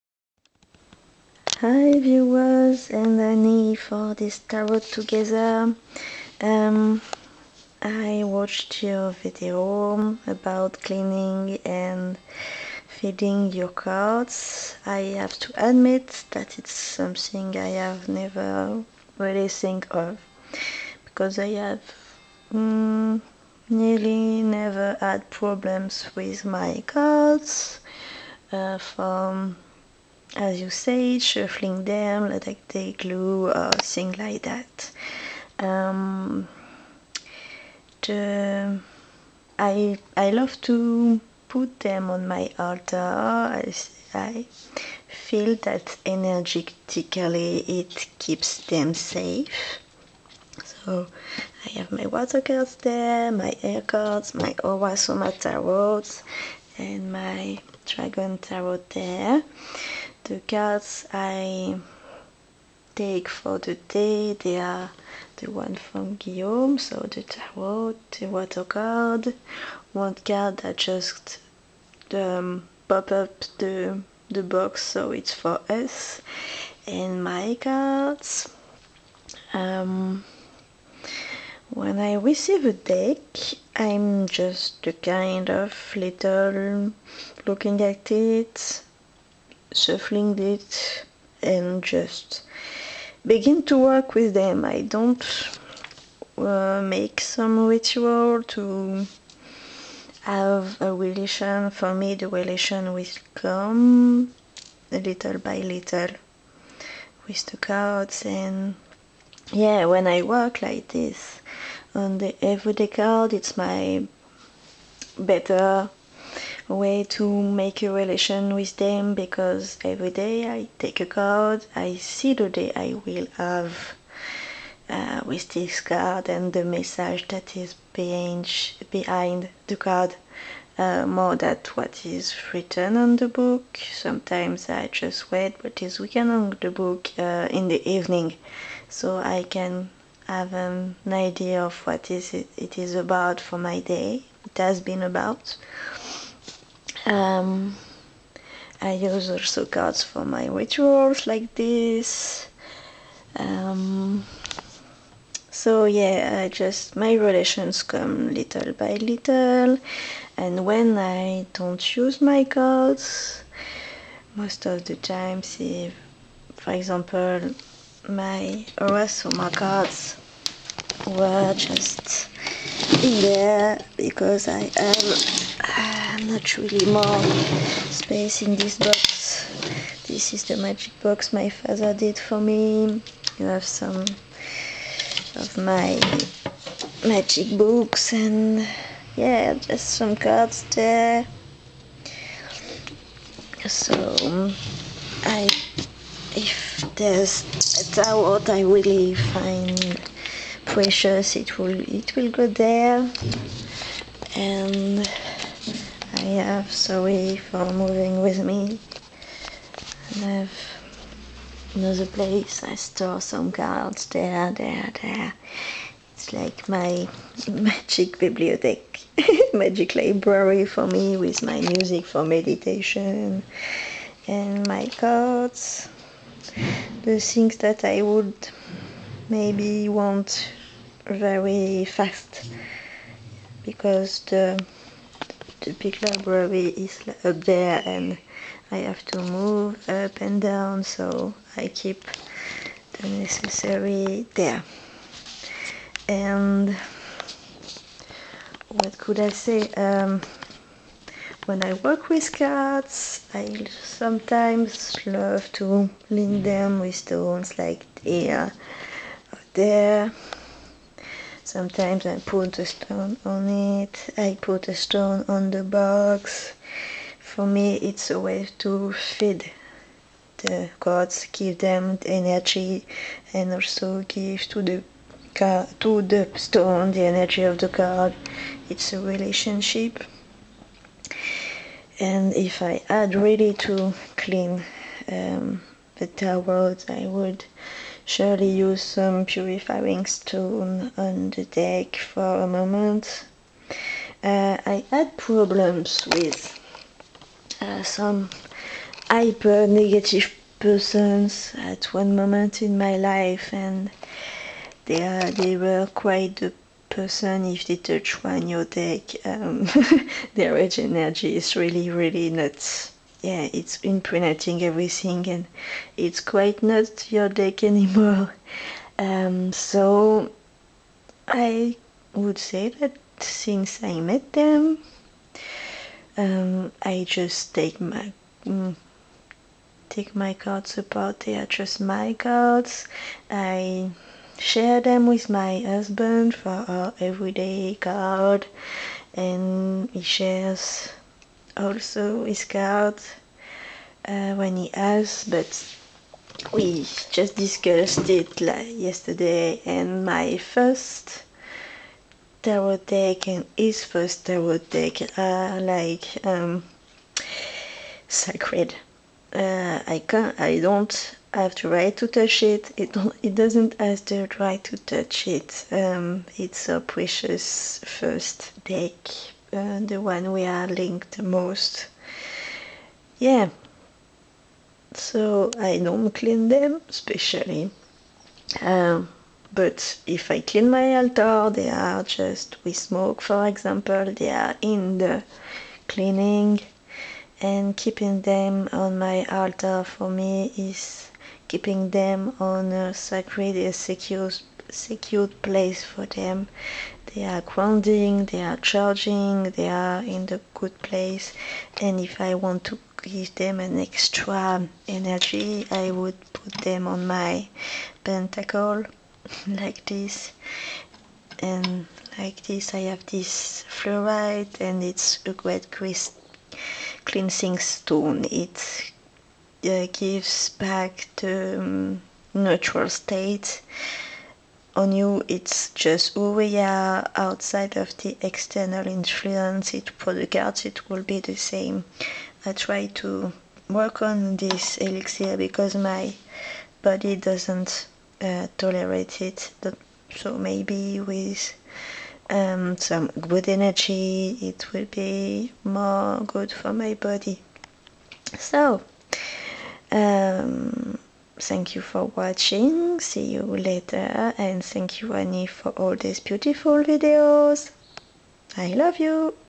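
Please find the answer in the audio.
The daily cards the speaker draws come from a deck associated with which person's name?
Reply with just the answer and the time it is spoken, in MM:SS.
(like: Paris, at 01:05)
Guillaume, at 01:06.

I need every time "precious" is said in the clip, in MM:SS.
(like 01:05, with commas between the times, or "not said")
03:20, 06:06.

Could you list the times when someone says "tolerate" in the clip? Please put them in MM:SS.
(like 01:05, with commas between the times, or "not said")
07:18.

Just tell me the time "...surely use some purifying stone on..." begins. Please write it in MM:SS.
04:48.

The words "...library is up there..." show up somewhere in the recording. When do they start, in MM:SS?
03:56.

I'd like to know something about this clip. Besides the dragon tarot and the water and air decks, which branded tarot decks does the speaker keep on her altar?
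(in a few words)
Aura-Soma tarots.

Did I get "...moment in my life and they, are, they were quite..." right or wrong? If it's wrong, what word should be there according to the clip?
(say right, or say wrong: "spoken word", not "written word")
right.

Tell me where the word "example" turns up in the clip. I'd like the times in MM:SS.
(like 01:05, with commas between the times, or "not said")
02:46, 06:23.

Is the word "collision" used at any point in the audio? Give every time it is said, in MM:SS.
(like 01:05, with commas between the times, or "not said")
not said.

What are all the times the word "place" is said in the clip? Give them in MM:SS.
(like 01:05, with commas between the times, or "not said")
03:32, 06:35, 06:40.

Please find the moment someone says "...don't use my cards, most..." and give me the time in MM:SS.
02:41.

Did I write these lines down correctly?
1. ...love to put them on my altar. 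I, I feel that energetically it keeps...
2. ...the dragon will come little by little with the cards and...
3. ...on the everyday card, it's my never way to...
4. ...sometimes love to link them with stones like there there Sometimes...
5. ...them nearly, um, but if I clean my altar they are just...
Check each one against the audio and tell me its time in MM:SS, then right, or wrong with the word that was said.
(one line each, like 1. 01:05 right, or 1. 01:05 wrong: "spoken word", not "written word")
1. 00:40 right
2. 01:42 wrong: "relation", not "dragon"
3. 01:51 wrong: "better", not "never"
4. 04:13 right
5. 06:16 wrong: "specially", not "nearly".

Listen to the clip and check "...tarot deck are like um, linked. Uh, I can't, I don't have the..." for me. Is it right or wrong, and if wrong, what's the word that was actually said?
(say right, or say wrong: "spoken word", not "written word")
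wrong: "sacred", not "linked".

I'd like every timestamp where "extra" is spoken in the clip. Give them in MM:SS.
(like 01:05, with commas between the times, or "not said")
06:43.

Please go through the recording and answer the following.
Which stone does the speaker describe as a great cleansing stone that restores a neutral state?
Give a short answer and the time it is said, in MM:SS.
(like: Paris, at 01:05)
Fluorite, at 06:53.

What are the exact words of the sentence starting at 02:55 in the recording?
Um, i have not really more space in this box.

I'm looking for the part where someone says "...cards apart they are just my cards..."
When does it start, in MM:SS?
05:30.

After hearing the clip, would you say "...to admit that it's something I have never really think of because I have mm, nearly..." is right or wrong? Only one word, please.
right.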